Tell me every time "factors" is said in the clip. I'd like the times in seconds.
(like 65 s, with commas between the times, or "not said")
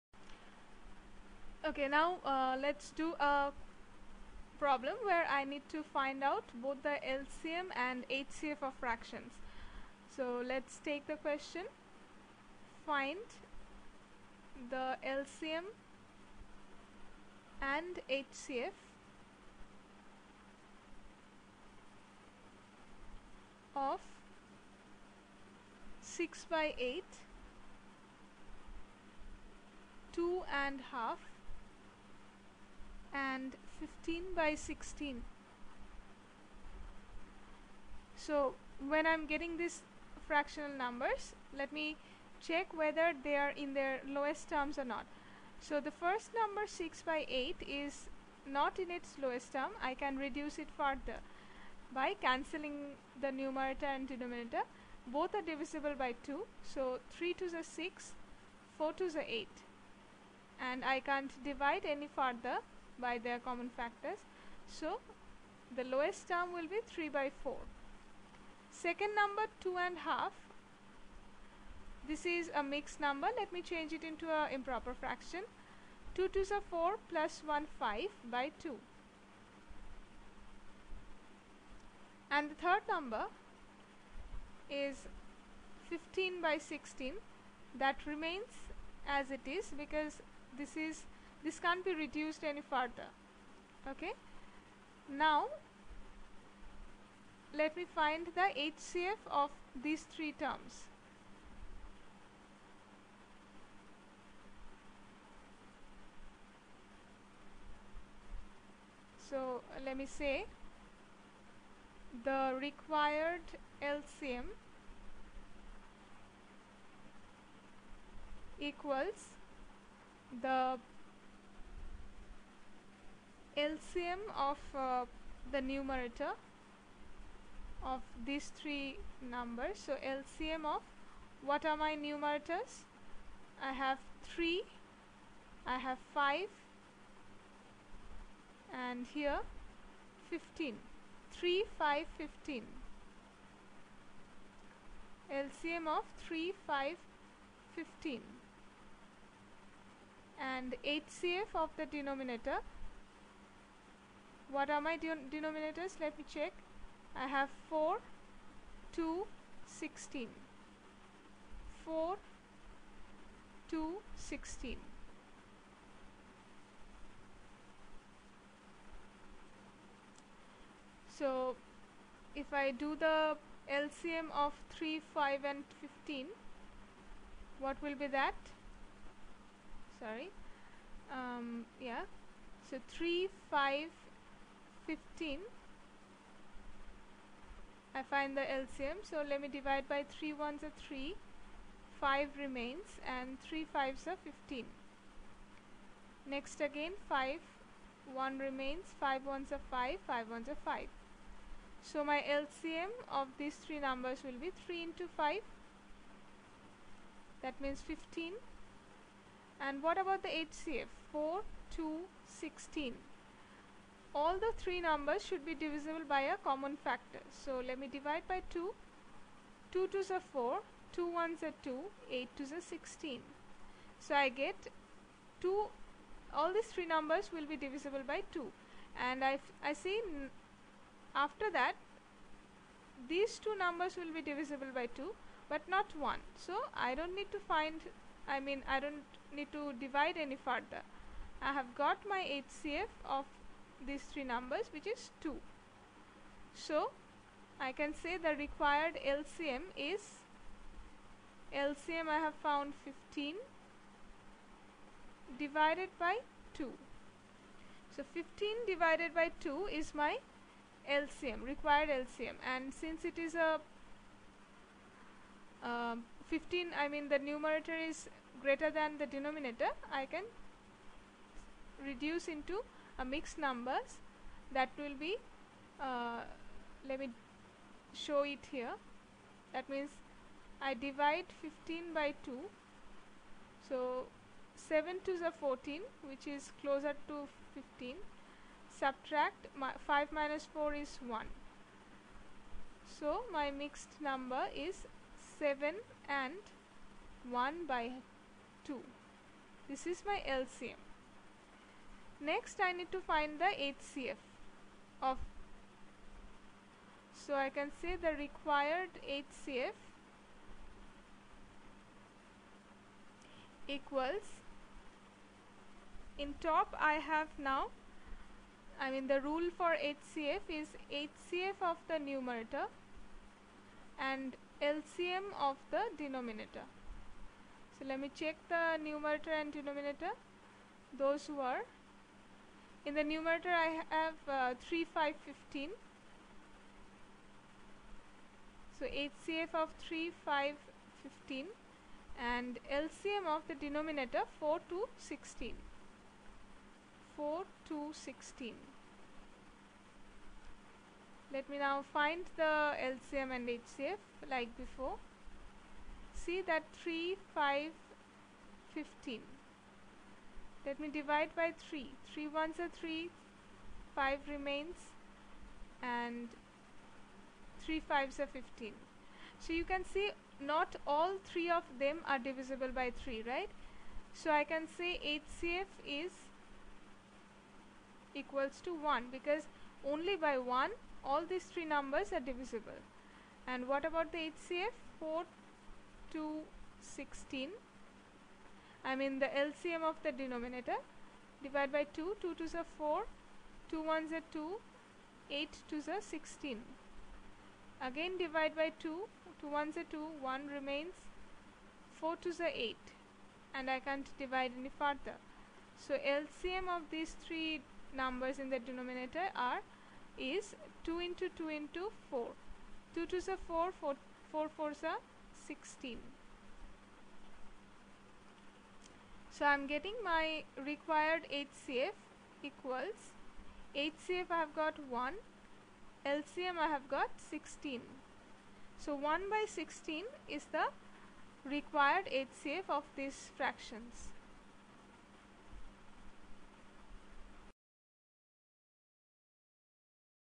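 63 s, 216 s.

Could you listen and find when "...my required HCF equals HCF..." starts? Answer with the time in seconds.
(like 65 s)
420 s.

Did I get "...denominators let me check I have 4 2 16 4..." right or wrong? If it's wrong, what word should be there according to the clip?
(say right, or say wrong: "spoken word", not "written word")
right.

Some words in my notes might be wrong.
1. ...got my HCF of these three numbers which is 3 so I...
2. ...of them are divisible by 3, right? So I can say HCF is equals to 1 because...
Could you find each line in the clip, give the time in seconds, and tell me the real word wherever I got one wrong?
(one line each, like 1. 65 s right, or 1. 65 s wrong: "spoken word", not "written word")
1. 241 s wrong: "2", not "3"
2. 371 s right.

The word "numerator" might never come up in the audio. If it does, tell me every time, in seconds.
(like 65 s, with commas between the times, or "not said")
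53 s, 125 s, 131 s, 267 s, 321 s, 328 s, 333 s.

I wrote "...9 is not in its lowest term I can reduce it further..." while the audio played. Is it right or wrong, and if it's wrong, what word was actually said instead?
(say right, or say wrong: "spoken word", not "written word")
wrong: "8", not "9".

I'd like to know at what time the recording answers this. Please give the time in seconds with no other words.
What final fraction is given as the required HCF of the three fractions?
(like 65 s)
428 s.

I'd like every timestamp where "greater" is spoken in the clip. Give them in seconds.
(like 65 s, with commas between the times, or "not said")
268 s.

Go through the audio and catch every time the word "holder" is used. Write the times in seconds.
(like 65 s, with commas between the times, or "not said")
not said.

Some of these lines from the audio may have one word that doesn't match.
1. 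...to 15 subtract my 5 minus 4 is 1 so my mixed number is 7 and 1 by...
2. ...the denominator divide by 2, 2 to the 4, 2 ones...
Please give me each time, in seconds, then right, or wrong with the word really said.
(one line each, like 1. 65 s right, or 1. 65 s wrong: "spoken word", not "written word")
1. 287 s right
2. 390 s right.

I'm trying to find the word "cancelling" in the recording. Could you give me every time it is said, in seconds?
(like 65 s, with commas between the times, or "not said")
52 s.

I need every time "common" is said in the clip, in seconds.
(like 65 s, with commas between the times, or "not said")
63 s, 216 s.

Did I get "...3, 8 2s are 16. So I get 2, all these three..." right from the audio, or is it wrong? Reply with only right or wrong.
wrong.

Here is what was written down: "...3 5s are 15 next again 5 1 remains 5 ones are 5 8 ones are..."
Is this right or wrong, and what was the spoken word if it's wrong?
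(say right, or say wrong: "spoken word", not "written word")
wrong: "5", not "8".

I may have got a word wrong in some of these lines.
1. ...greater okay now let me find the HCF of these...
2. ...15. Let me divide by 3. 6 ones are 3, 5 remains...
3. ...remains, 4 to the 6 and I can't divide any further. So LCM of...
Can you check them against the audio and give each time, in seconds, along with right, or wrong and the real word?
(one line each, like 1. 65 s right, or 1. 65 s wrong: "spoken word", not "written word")
1. 92 s wrong: "further", not "greater"
2. 358 s wrong: "3", not "6"
3. 400 s wrong: "8", not "6".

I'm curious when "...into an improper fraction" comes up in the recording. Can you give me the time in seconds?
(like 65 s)
74 s.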